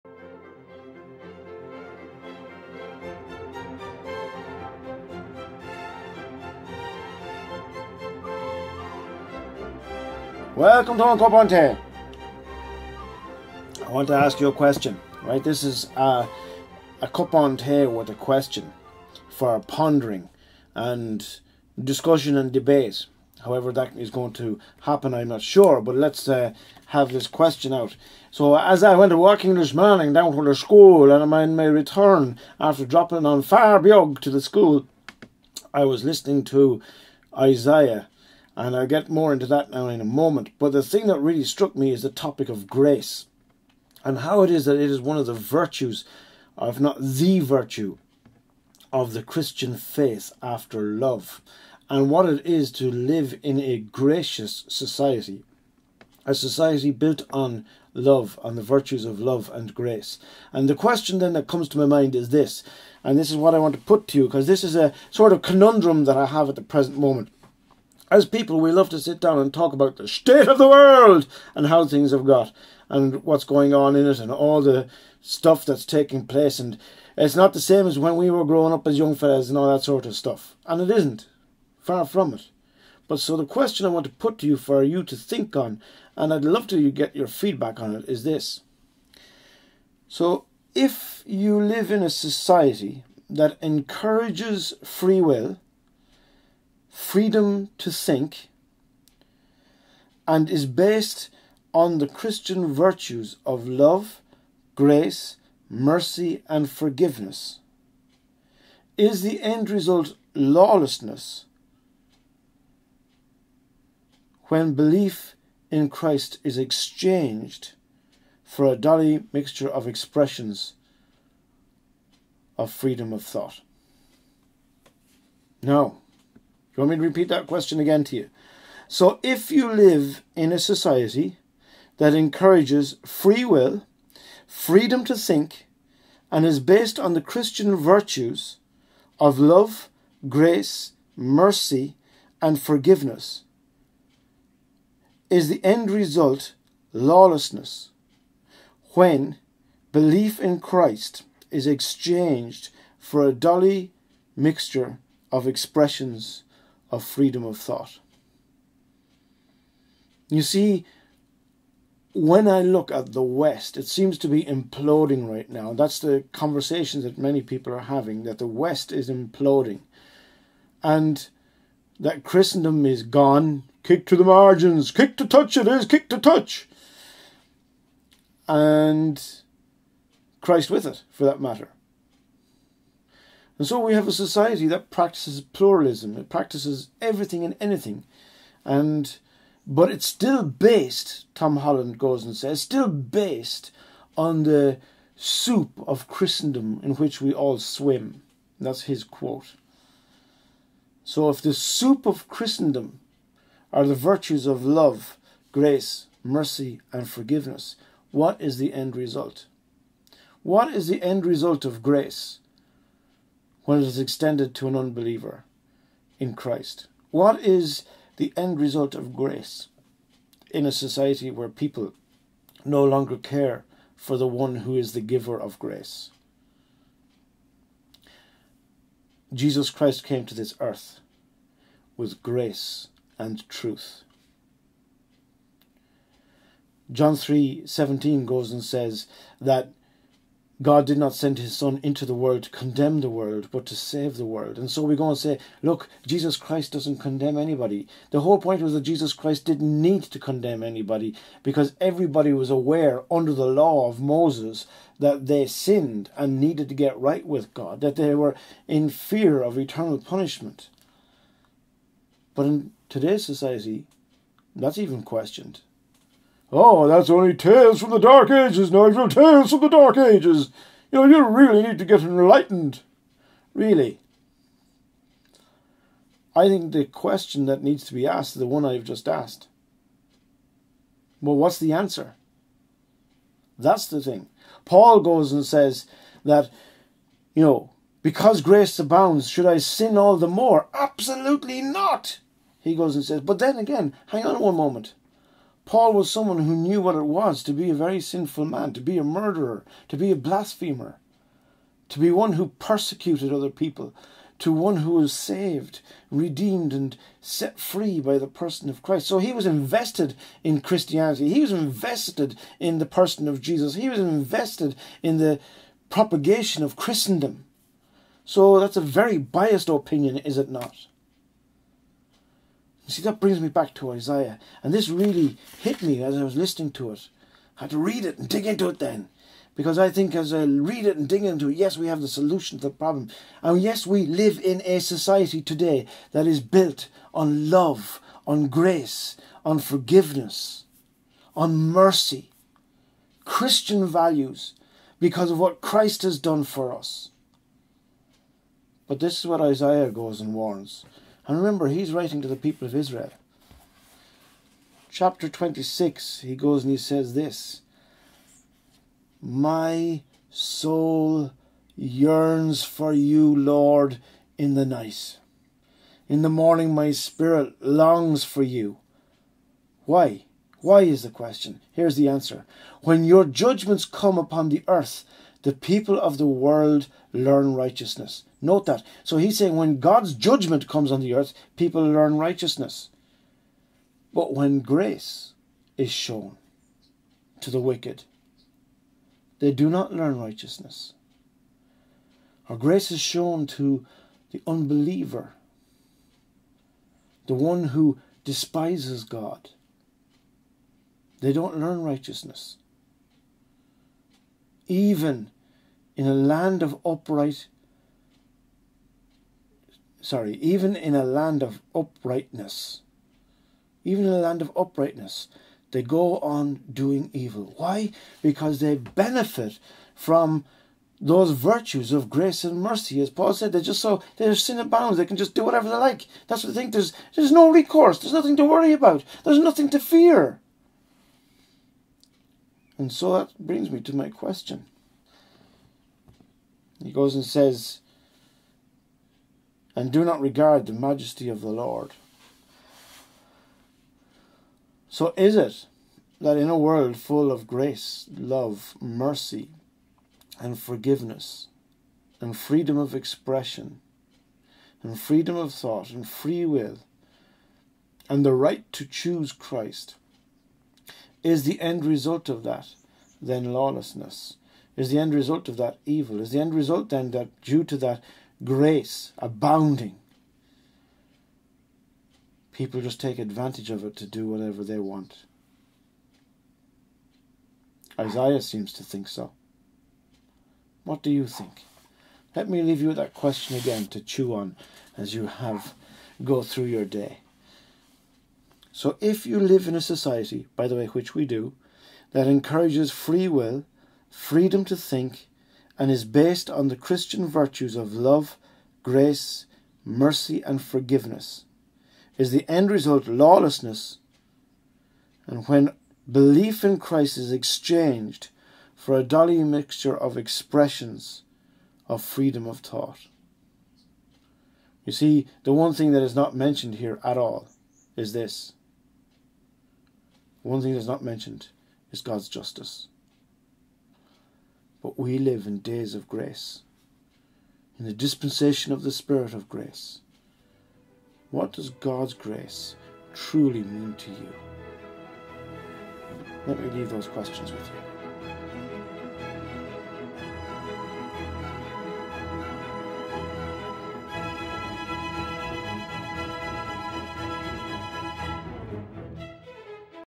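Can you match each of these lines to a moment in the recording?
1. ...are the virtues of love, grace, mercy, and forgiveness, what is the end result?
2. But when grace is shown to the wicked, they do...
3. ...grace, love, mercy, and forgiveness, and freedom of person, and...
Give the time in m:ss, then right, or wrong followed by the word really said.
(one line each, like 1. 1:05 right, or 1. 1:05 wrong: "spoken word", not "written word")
1. 3:23 right
2. 6:24 right
3. 7:27 wrong: "expression", not "person".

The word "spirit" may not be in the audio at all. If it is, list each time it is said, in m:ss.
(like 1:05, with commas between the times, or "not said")
6:06, 8:48.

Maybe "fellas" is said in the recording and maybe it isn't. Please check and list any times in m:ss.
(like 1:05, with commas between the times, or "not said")
1:19.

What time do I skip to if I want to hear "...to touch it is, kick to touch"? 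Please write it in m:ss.
2:55.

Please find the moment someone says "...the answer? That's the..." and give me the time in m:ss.
4:41.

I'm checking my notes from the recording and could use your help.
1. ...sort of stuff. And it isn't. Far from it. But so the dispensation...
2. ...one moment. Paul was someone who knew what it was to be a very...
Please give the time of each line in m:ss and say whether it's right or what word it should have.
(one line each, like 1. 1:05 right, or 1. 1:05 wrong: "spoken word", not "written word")
1. 1:19 wrong: "question", not "dispensation"
2. 4:54 right.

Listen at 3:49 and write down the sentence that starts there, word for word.
Jesus Christ came to this earth with grace and truth.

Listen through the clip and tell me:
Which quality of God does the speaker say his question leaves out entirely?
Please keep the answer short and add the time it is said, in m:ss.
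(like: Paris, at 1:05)
justice, at 8:42.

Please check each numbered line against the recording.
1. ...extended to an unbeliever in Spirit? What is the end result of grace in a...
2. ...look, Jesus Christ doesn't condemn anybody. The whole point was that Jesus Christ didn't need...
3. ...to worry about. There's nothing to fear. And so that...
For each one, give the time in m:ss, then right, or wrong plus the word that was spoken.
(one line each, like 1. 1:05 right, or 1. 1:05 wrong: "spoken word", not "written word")
1. 3:33 wrong: "Christ", not "Spirit"
2. 4:05 right
3. 7:08 right.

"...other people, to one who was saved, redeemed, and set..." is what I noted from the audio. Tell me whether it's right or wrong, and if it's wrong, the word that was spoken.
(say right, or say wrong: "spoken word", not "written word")
right.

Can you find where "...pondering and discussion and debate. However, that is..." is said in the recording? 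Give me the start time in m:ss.
0:19.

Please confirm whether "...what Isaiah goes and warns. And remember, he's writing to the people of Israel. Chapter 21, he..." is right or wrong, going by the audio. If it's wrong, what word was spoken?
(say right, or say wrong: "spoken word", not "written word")
wrong: "26", not "21".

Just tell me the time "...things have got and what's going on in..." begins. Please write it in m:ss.
1:11.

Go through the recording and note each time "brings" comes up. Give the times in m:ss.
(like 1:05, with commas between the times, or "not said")
5:23, 7:13.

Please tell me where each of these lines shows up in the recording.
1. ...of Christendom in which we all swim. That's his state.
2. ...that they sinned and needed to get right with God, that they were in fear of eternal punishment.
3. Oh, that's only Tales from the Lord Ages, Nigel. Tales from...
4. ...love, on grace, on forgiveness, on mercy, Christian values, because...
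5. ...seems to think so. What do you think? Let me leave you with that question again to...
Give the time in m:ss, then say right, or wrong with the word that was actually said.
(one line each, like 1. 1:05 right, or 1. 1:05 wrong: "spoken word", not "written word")
1. 3:15 wrong: "quote", not "state"
2. 4:14 right
3. 4:26 wrong: "Dark", not "Lord"
4. 5:37 right
5. 7:58 right.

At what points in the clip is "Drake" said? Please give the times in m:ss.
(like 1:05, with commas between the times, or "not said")
not said.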